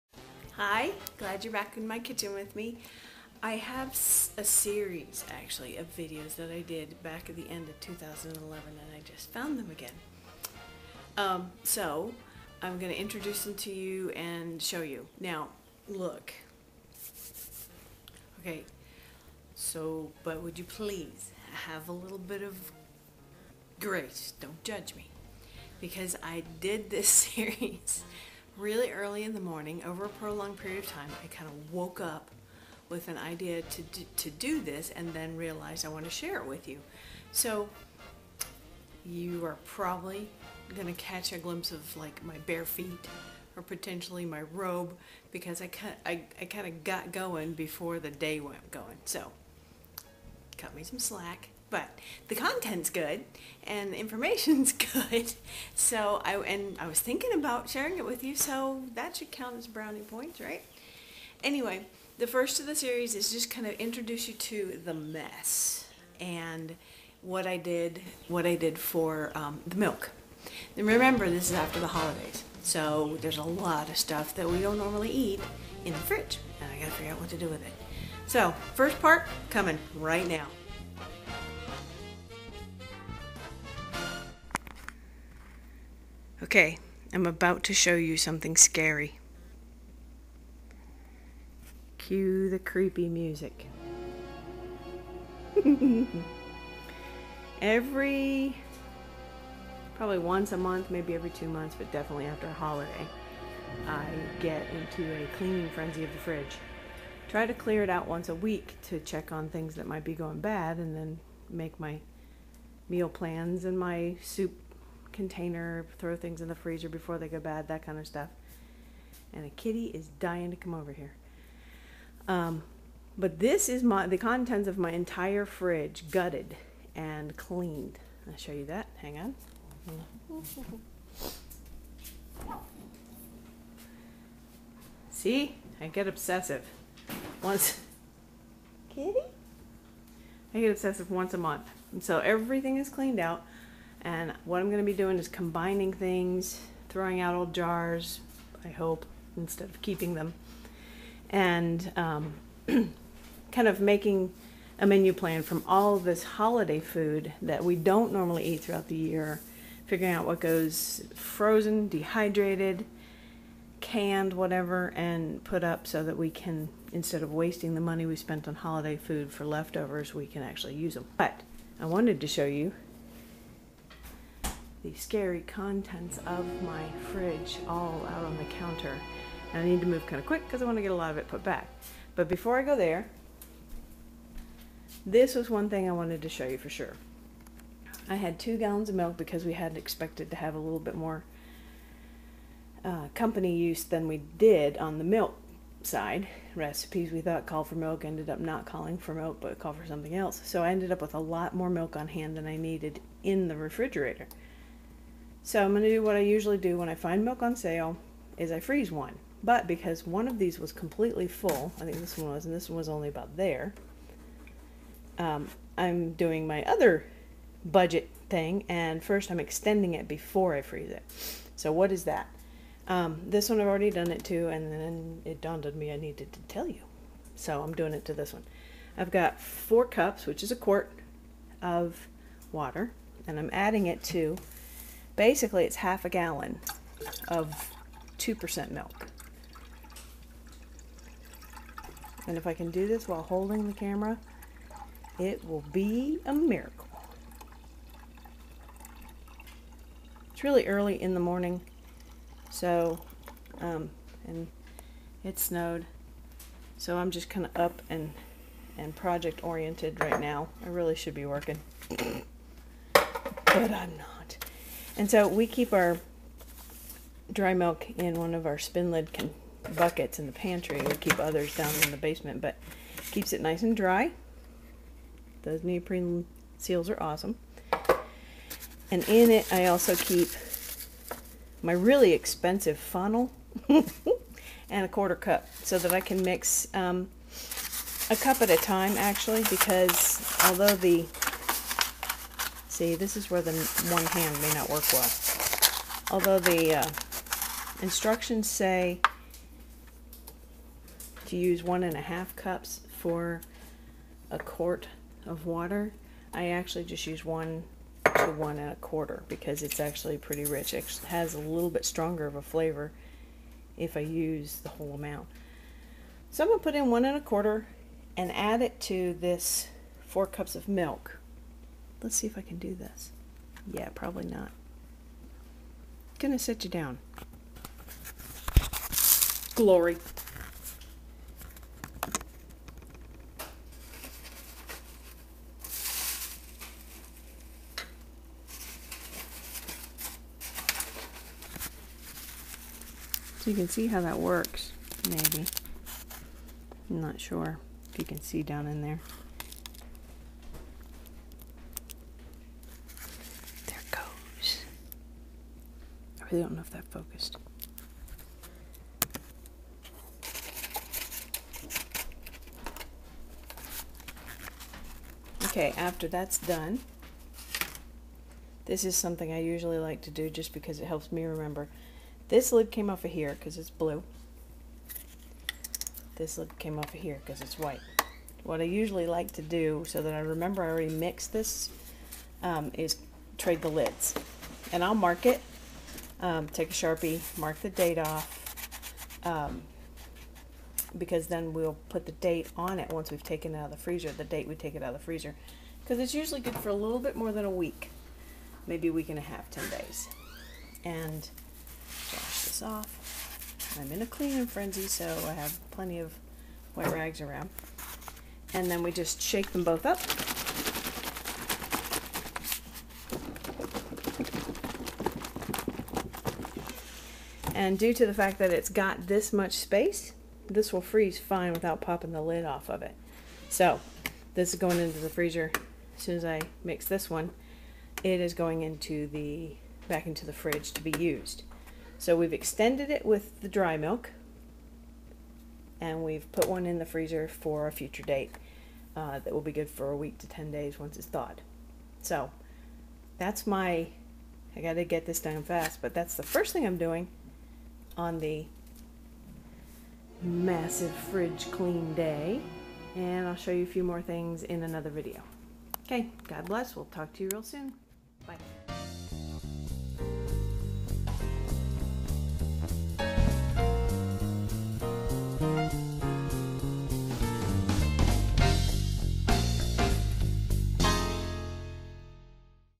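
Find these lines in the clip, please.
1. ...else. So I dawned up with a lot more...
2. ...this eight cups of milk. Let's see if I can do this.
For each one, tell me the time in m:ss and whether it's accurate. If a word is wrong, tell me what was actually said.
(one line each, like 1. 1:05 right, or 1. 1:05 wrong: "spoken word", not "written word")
1. 3:20 wrong: "ended", not "dawned"
2. 5:19 wrong: "four", not "eight".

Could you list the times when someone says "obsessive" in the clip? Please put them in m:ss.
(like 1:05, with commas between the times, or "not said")
2:16, 2:20.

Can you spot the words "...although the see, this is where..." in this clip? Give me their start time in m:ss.
4:50.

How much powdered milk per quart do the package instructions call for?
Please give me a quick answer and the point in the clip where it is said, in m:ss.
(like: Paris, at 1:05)
1 1/2 cups, at 5:01.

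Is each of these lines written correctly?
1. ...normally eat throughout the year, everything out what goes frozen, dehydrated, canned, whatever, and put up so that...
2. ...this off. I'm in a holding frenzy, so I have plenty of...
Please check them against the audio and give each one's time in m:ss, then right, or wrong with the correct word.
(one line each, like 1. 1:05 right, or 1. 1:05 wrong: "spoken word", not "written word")
1. 2:38 wrong: "figuring", not "everything"
2. 6:42 wrong: "cleaning", not "holding".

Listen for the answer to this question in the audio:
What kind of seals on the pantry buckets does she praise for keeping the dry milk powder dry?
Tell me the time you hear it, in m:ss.
4:35.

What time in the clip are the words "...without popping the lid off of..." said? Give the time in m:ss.
7:01.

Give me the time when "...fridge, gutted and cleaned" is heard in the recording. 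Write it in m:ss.
2:05.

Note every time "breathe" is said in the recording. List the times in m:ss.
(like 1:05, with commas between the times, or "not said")
not said.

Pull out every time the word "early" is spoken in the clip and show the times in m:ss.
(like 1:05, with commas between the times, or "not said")
0:28, 4:10.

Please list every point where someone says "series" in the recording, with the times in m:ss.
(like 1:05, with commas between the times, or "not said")
0:04, 0:27, 1:02.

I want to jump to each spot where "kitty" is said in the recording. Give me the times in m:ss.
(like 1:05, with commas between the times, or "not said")
1:59, 2:18.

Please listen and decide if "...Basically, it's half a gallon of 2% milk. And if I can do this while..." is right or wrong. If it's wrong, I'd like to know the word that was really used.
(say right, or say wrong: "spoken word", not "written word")
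right.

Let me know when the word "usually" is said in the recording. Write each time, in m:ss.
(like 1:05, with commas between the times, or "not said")
3:26, 6:09, 6:18, 6:36.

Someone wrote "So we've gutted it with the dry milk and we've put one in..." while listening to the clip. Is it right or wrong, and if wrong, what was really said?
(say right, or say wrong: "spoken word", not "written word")
wrong: "extended", not "gutted".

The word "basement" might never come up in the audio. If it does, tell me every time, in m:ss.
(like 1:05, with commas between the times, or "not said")
4:31.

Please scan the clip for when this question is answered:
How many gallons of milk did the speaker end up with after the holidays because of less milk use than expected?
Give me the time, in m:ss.
3:08.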